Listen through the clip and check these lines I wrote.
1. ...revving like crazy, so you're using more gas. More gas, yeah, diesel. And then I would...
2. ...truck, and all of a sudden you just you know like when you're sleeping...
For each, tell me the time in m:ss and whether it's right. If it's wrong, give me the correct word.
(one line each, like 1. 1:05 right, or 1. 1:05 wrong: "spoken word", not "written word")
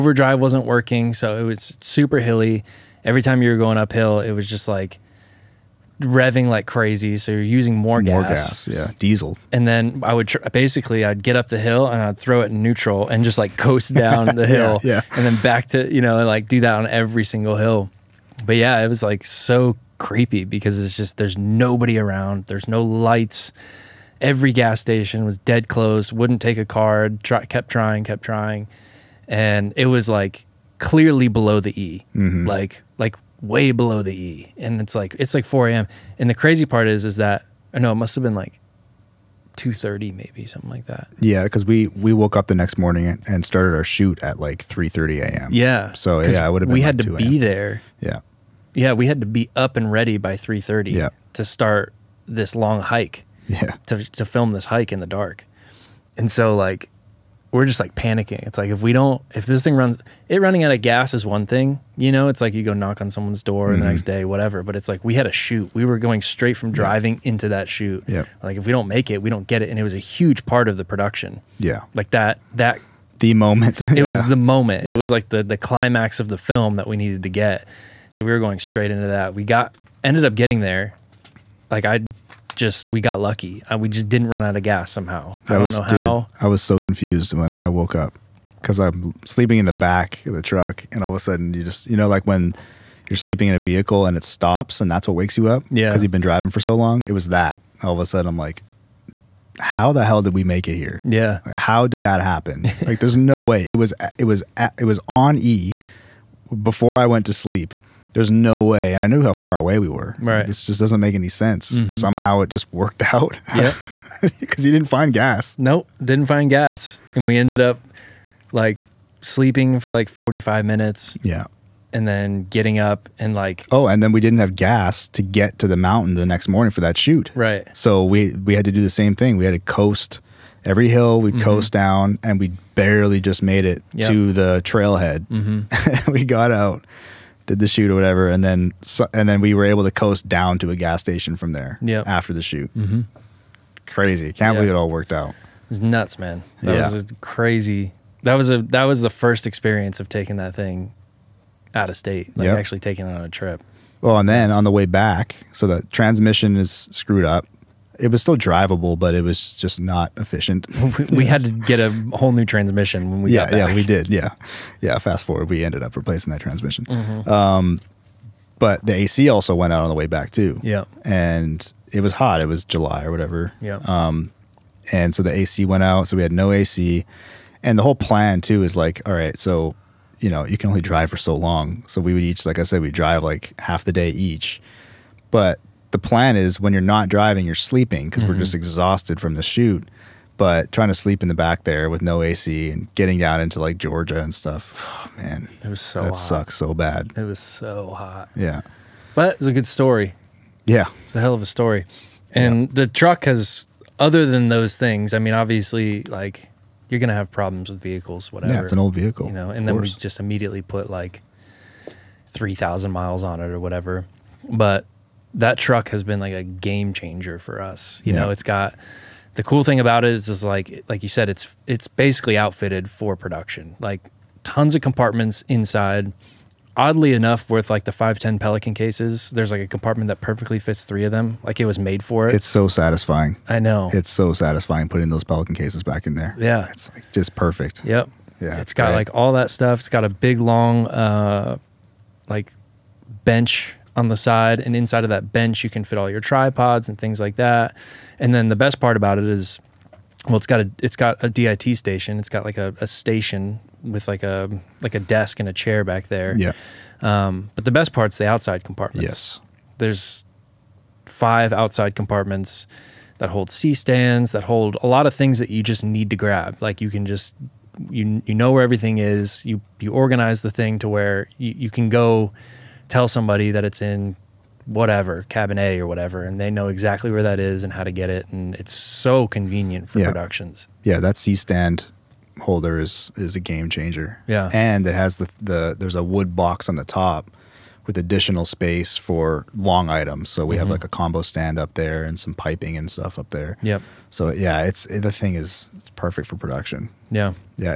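1. 0:05 right
2. 1:30 right.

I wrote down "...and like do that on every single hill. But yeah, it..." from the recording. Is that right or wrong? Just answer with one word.
right.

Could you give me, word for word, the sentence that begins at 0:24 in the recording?
Every gas station was dead closed.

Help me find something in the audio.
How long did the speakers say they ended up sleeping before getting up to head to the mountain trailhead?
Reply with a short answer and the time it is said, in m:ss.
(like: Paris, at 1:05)
45 minutes, at 2:00.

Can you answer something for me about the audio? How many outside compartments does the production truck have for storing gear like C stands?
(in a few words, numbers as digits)
5.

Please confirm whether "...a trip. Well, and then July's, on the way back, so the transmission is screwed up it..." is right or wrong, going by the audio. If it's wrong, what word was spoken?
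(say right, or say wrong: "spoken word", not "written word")
wrong: "That", not "July".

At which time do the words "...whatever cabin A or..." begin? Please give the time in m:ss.
4:34.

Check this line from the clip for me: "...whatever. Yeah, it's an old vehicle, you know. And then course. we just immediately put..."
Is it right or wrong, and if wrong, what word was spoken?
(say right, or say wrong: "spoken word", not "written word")
right.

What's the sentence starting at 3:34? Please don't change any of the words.
But that truck has been like a game changer for us.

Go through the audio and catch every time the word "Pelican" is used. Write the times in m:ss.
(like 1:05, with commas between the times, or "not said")
3:48, 3:55.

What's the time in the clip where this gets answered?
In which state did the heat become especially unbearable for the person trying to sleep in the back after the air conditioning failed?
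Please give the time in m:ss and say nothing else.
3:13.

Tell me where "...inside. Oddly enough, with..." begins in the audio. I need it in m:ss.
3:45.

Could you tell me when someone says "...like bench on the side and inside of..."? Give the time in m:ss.
4:02.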